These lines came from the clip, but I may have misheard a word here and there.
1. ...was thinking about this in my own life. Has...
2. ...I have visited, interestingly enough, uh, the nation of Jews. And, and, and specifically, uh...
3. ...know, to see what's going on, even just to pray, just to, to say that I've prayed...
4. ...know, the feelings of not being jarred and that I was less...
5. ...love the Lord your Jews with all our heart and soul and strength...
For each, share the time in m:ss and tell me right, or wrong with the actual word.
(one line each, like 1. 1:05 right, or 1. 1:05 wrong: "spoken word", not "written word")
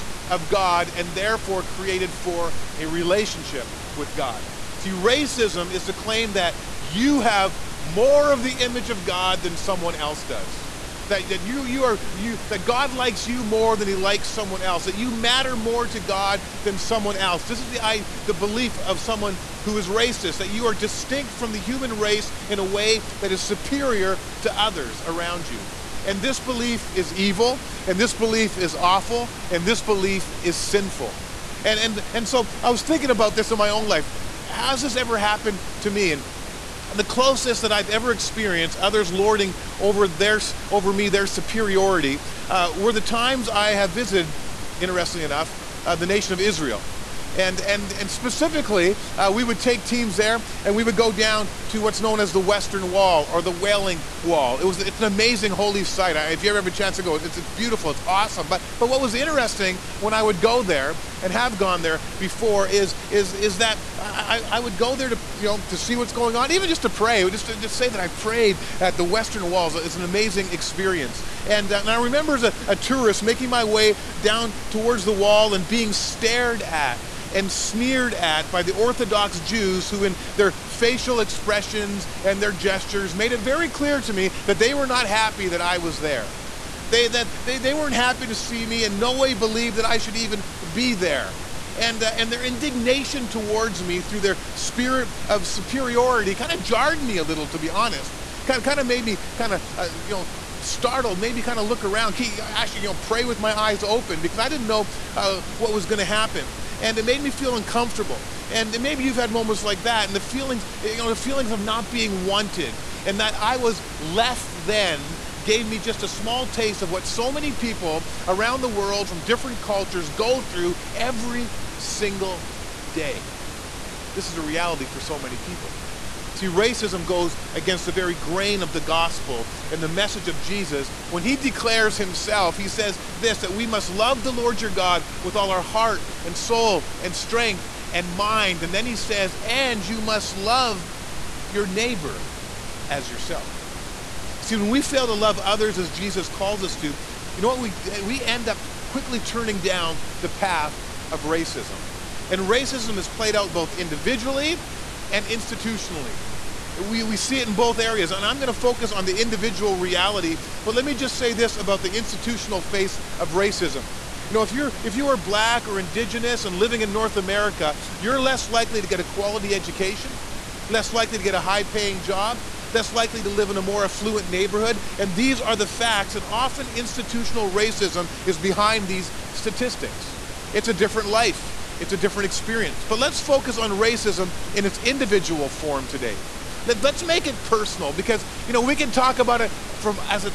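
1. 0:32 right
2. 0:43 wrong: "Israel", not "Jews"
3. 1:05 right
4. 1:50 wrong: "wanted", not "jarred"
5. 2:13 wrong: "God", not "Jews".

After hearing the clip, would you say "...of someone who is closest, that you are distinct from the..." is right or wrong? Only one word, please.
wrong.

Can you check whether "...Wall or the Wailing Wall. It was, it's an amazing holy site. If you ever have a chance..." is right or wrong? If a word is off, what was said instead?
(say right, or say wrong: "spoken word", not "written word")
right.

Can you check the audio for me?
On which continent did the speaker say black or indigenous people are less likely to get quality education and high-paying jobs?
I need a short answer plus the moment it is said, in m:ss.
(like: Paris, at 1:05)
North America, at 2:46.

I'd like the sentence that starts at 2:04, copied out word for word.
This is a reality for so many people.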